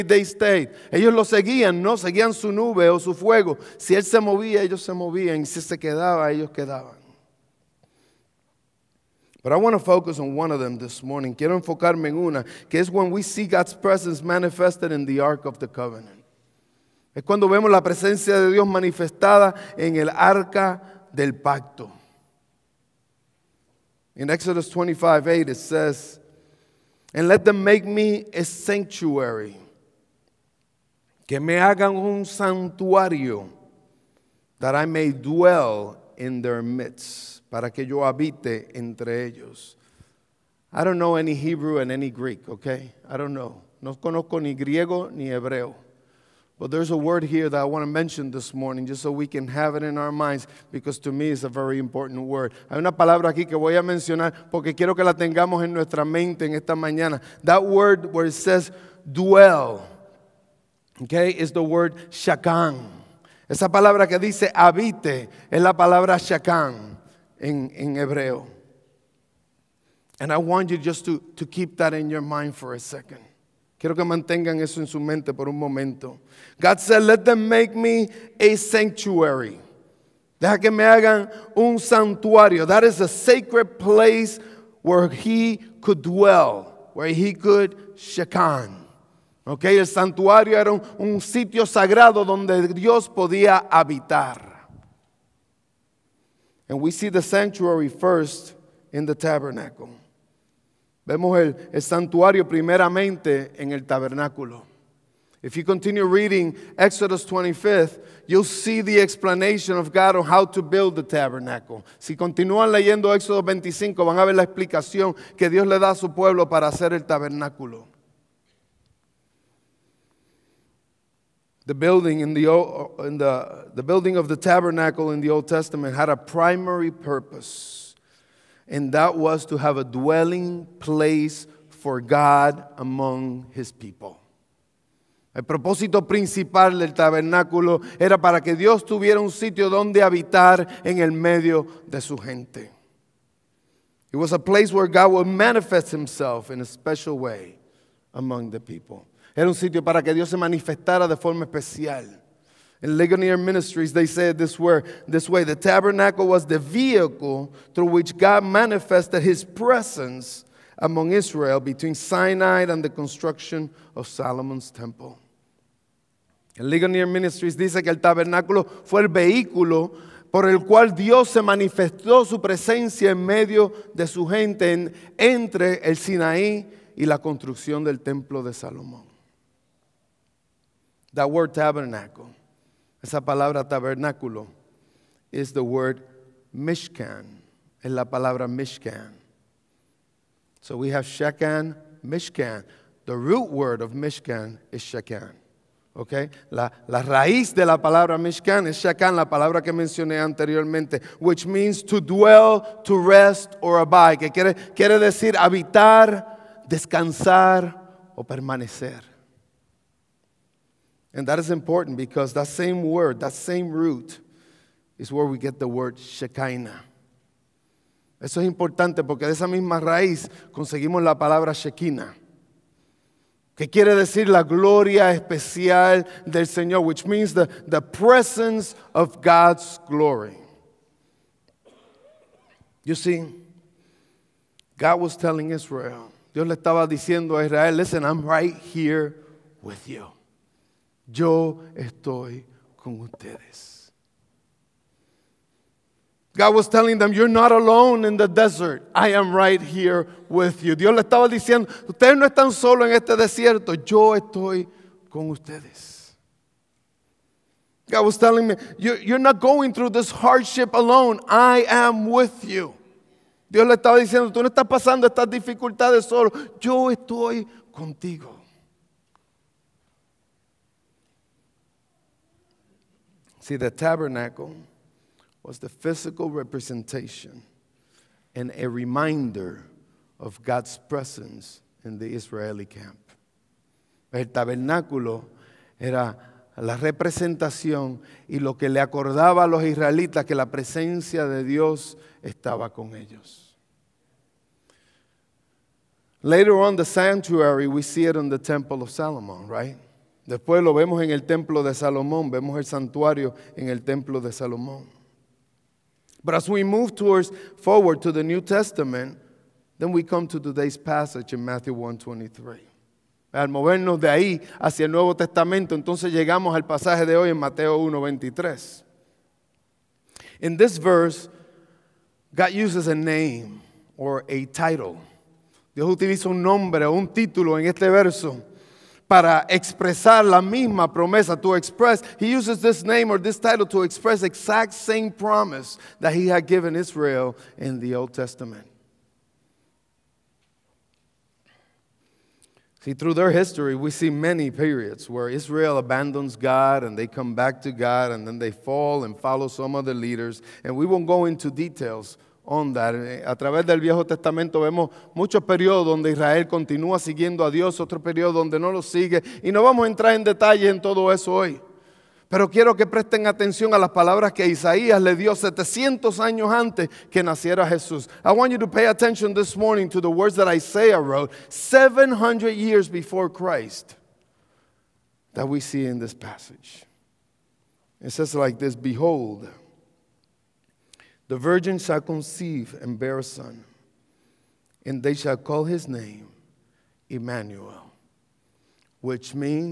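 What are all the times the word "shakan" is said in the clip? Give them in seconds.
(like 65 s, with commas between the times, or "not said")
62 s, 66 s.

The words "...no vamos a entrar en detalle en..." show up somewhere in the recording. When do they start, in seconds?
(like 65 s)
359 s.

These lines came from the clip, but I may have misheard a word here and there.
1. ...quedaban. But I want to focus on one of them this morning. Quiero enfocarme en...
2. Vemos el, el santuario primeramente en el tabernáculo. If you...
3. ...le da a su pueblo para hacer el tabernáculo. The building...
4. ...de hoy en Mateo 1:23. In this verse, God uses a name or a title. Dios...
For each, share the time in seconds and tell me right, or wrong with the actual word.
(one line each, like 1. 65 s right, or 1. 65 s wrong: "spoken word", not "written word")
1. 6 s right
2. 101 s right
3. 115 s right
4. 317 s right.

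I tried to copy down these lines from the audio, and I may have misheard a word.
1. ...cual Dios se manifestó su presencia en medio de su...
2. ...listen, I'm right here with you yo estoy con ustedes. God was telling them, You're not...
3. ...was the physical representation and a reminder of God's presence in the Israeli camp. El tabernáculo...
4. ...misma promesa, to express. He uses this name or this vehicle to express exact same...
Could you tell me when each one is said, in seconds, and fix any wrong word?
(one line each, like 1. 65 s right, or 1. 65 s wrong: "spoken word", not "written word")
1. 170 s right
2. 237 s right
3. 275 s right
4. 330 s wrong: "title", not "vehicle".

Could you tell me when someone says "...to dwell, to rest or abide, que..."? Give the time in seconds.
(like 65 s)
201 s.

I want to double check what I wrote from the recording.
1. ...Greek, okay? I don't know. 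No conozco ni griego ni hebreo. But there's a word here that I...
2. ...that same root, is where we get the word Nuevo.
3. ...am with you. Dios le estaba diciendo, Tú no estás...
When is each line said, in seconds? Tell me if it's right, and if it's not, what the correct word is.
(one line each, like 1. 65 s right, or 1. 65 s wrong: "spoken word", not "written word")
1. 42 s right
2. 213 s wrong: "Shekinah", not "Nuevo"
3. 261 s right.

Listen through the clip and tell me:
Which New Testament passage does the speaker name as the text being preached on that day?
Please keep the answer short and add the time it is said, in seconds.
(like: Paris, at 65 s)
Matthew 1:23, at 311 s.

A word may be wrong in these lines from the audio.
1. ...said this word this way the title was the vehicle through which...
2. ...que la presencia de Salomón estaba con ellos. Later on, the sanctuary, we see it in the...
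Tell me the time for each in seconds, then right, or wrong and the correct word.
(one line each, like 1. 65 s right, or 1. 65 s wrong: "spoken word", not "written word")
1. 154 s wrong: "tabernacle", not "title"
2. 290 s wrong: "Dios", not "Salomón".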